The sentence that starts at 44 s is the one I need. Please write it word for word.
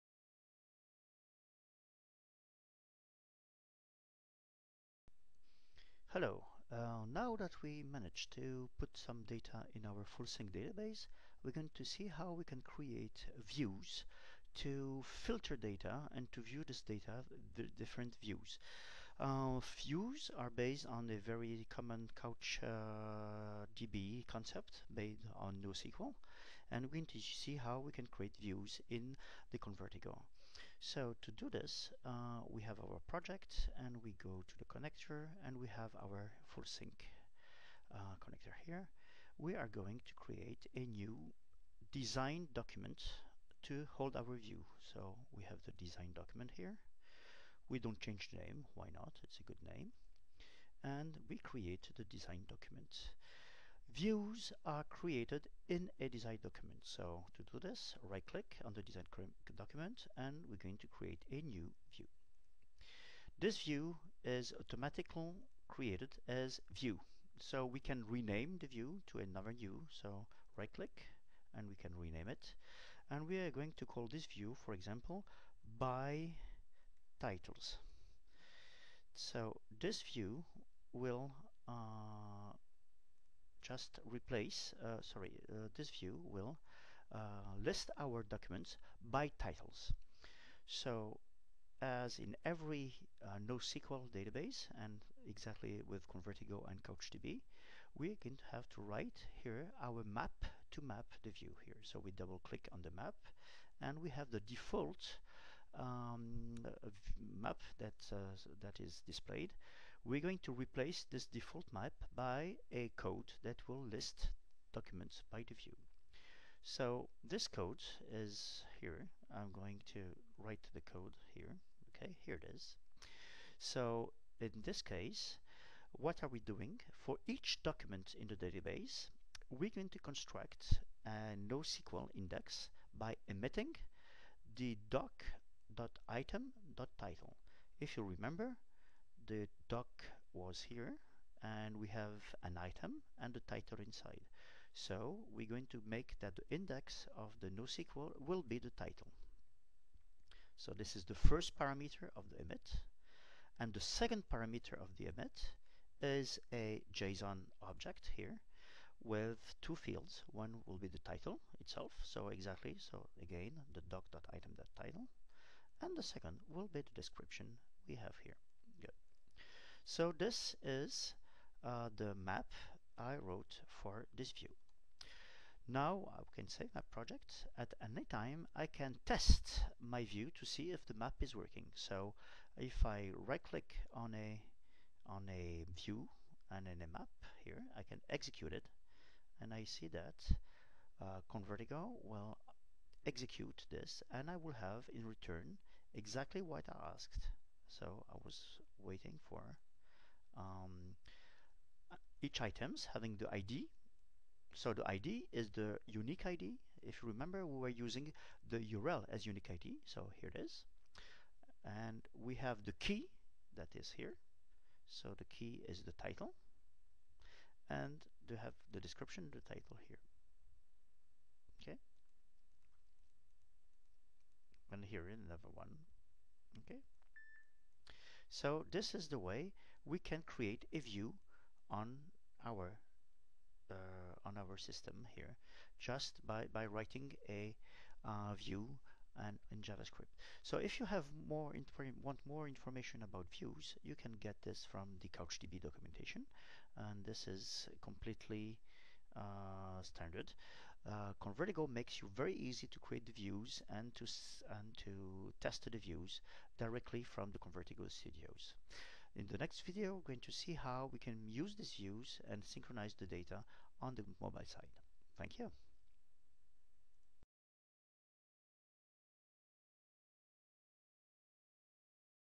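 So we have the design document here.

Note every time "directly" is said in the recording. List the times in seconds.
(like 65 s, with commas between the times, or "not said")
256 s.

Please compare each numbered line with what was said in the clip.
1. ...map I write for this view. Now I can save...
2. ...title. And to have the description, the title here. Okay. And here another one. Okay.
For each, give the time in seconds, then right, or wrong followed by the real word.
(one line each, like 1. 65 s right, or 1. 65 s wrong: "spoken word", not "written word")
1. 172 s wrong: "wrote", not "write"
2. 215 s right.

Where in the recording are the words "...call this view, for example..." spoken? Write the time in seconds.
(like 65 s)
73 s.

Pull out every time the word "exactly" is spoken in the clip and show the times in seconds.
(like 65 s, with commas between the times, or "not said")
95 s, 162 s, 195 s.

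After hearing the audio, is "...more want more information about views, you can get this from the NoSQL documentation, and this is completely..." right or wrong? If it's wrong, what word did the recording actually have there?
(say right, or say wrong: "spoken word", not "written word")
wrong: "CouchDB", not "NoSQL".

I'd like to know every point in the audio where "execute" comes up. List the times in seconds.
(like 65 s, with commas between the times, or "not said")
188 s, 193 s.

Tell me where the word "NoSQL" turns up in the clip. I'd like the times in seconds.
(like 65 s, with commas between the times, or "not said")
25 s, 93 s, 131 s, 147 s.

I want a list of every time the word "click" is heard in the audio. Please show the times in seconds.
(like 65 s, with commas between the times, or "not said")
58 s, 70 s, 102 s, 183 s.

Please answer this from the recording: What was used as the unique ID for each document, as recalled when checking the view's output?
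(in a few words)
the URL.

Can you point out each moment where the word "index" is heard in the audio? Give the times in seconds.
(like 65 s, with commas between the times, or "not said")
132 s, 146 s.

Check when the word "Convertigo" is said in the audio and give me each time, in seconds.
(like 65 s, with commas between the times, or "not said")
29 s, 96 s, 191 s, 251 s, 257 s.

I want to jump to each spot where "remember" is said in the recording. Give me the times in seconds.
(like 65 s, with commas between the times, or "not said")
138 s, 207 s.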